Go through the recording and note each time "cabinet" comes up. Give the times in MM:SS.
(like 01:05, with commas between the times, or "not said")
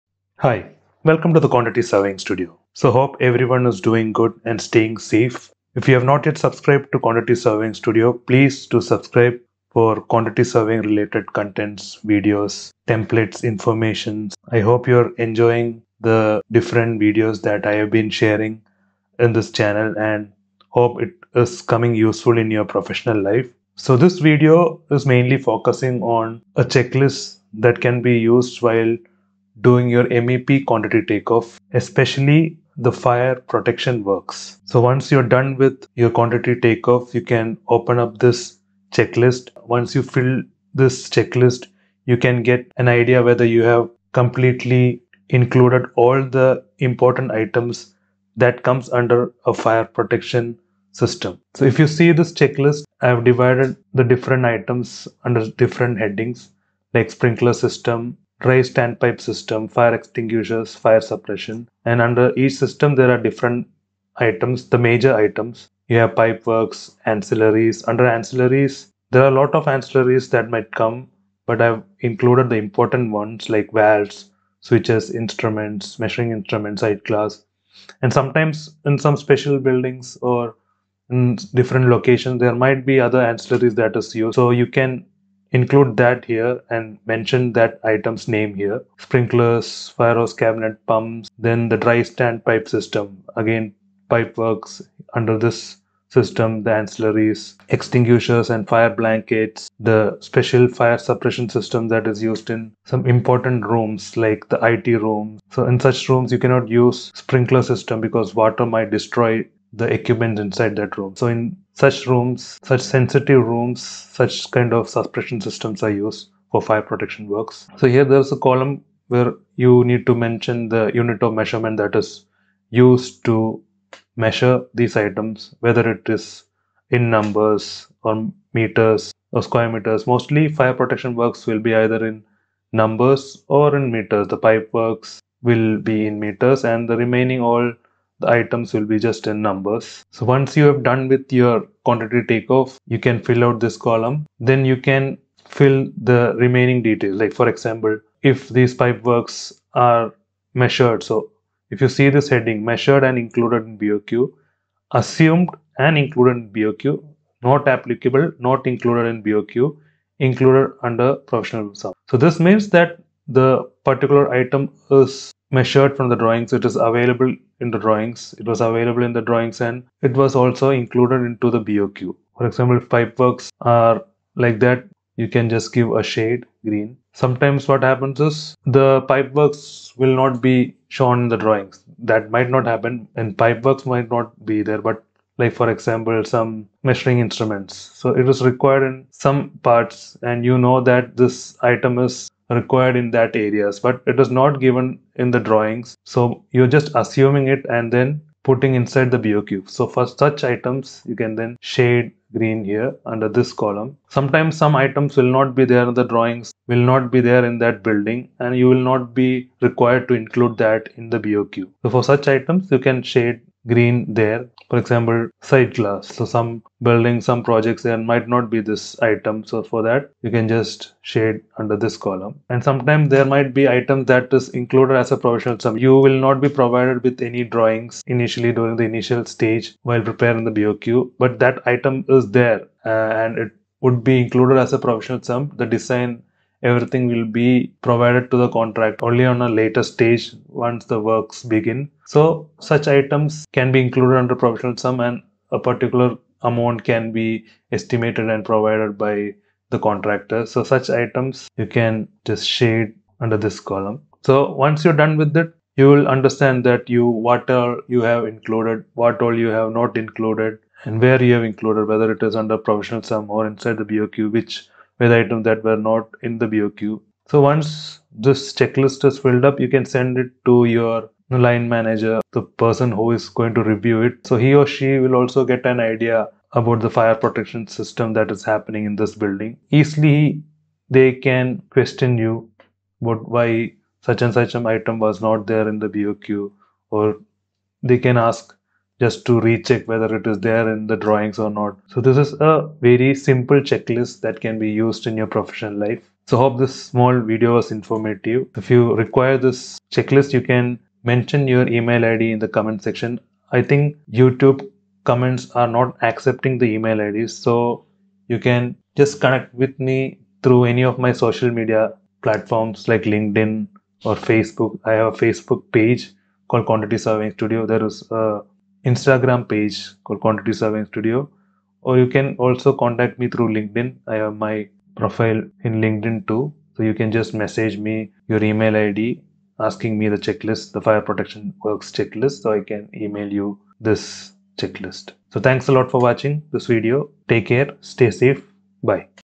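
01:30.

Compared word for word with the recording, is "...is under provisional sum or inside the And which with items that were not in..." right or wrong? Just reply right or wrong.
wrong.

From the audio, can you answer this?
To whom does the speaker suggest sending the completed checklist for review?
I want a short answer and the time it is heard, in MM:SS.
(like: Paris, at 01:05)
line manager, at 04:30.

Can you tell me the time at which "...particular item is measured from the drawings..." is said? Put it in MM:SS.
02:43.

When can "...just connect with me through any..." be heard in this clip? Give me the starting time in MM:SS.
05:08.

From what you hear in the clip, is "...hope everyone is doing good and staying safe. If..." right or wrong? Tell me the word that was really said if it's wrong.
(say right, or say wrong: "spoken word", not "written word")
right.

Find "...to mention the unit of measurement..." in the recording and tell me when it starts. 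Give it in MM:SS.
02:00.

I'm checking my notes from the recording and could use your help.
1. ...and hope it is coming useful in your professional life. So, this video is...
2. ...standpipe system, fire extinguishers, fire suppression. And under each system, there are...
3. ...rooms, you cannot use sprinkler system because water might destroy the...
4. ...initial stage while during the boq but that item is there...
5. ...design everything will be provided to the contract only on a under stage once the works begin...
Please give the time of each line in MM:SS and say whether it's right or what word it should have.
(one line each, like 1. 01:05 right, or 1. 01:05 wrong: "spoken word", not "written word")
1. 00:19 right
2. 00:58 right
3. 01:46 right
4. 03:48 wrong: "preparing", not "during"
5. 03:55 wrong: "later", not "under".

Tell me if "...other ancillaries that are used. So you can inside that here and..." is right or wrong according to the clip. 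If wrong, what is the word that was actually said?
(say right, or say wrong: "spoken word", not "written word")
wrong: "include", not "inside".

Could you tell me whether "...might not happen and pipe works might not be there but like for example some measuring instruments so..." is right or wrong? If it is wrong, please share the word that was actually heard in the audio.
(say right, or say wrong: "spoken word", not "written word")
right.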